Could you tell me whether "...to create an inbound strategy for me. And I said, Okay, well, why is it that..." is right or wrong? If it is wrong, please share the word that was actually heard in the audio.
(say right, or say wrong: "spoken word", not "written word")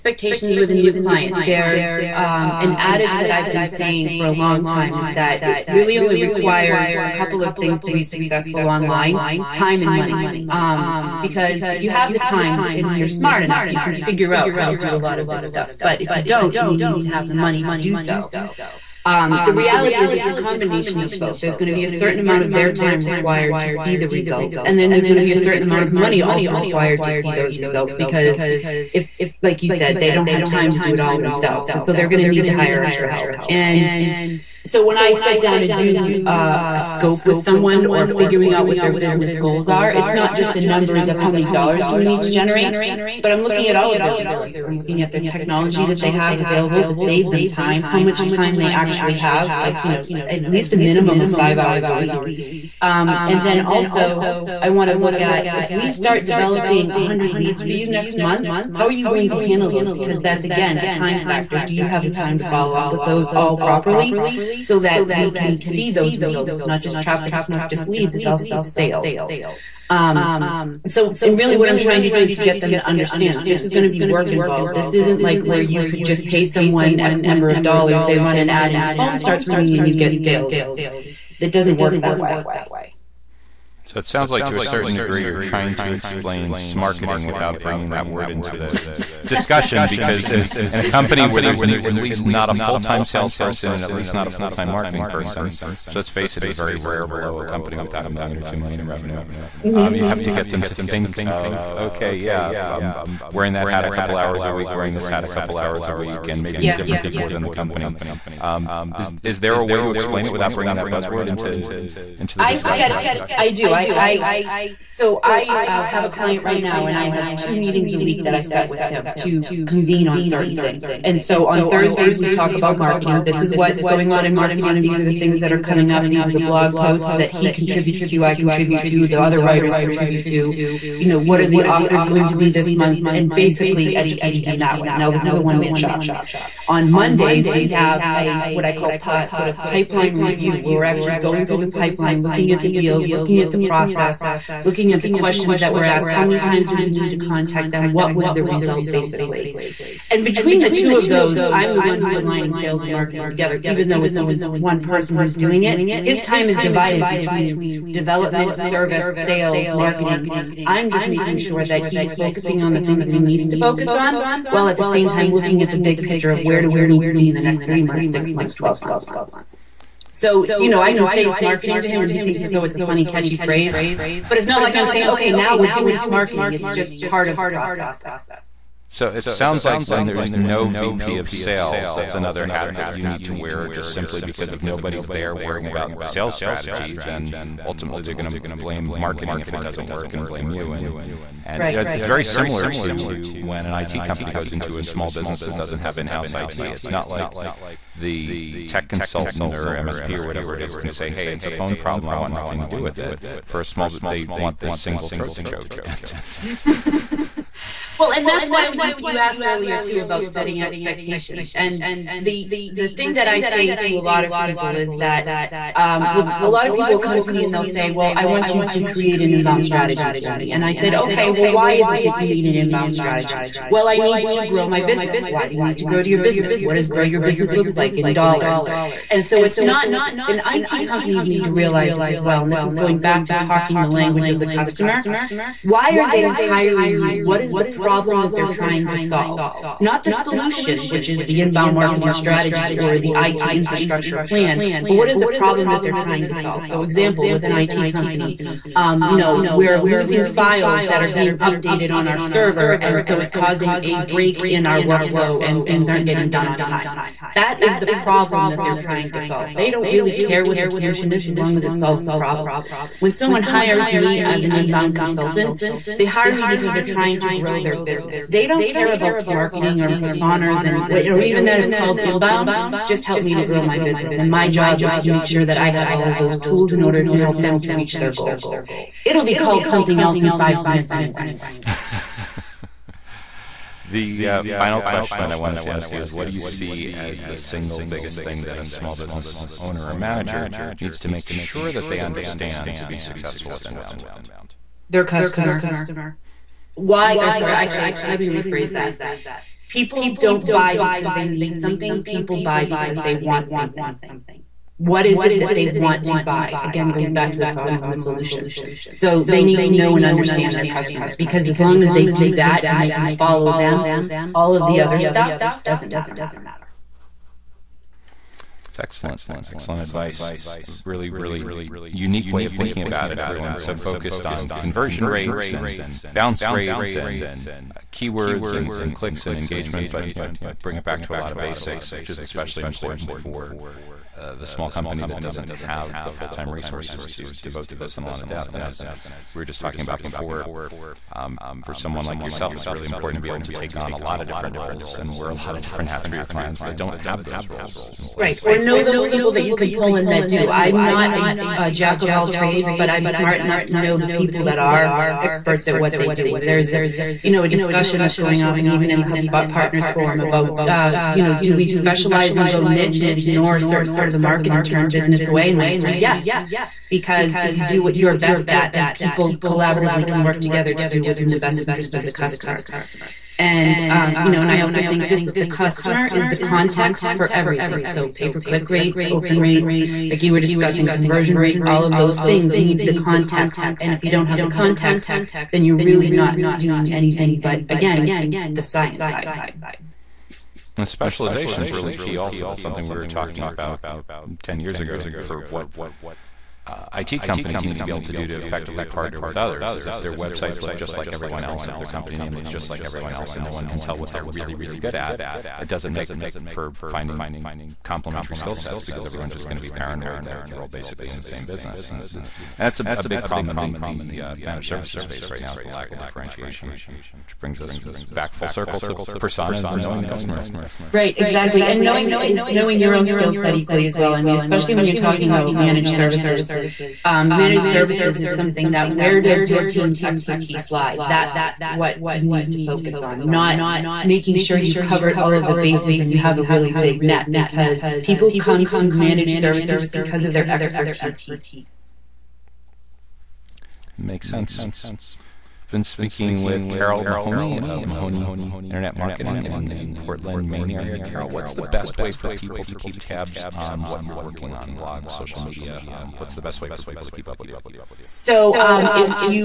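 right.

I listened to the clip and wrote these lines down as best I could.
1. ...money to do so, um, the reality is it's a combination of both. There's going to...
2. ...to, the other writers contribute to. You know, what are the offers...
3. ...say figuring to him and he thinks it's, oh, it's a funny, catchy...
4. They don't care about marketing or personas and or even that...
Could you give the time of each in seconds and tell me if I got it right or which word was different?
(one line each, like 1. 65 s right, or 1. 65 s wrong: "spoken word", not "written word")
1. 17 s right
2. 128 s right
3. 171 s wrong: "smarketing", not "figuring"
4. 268 s right.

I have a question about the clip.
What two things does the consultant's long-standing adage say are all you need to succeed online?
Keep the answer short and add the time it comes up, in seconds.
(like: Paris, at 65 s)
time and money, at 9 s.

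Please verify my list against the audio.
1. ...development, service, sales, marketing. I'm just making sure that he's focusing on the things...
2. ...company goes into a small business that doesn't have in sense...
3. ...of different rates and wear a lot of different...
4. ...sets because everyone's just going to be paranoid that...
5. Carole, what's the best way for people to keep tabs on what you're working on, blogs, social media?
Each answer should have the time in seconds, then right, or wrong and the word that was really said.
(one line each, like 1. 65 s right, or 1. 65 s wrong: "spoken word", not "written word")
1. 157 s right
2. 194 s wrong: "house", not "sense"
3. 344 s wrong: "roles", not "rates"
4. 408 s right
5. 450 s right.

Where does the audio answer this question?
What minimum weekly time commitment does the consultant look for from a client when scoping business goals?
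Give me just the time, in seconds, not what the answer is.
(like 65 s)
51 s.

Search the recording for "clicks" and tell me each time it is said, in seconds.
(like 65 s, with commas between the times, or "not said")
328 s, 378 s.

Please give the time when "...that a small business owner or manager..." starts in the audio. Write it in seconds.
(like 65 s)
288 s.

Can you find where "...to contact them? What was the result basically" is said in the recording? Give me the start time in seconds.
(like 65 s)
147 s.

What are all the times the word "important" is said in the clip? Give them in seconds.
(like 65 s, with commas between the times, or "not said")
332 s, 342 s.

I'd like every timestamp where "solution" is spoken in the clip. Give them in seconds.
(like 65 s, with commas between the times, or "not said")
240 s, 260 s, 307 s.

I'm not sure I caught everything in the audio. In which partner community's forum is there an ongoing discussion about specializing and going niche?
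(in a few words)
HubSpot Partners Forum.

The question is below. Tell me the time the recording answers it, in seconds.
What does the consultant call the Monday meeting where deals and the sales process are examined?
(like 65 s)
139 s.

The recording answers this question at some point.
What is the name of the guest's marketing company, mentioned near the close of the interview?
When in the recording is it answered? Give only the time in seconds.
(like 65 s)
447 s.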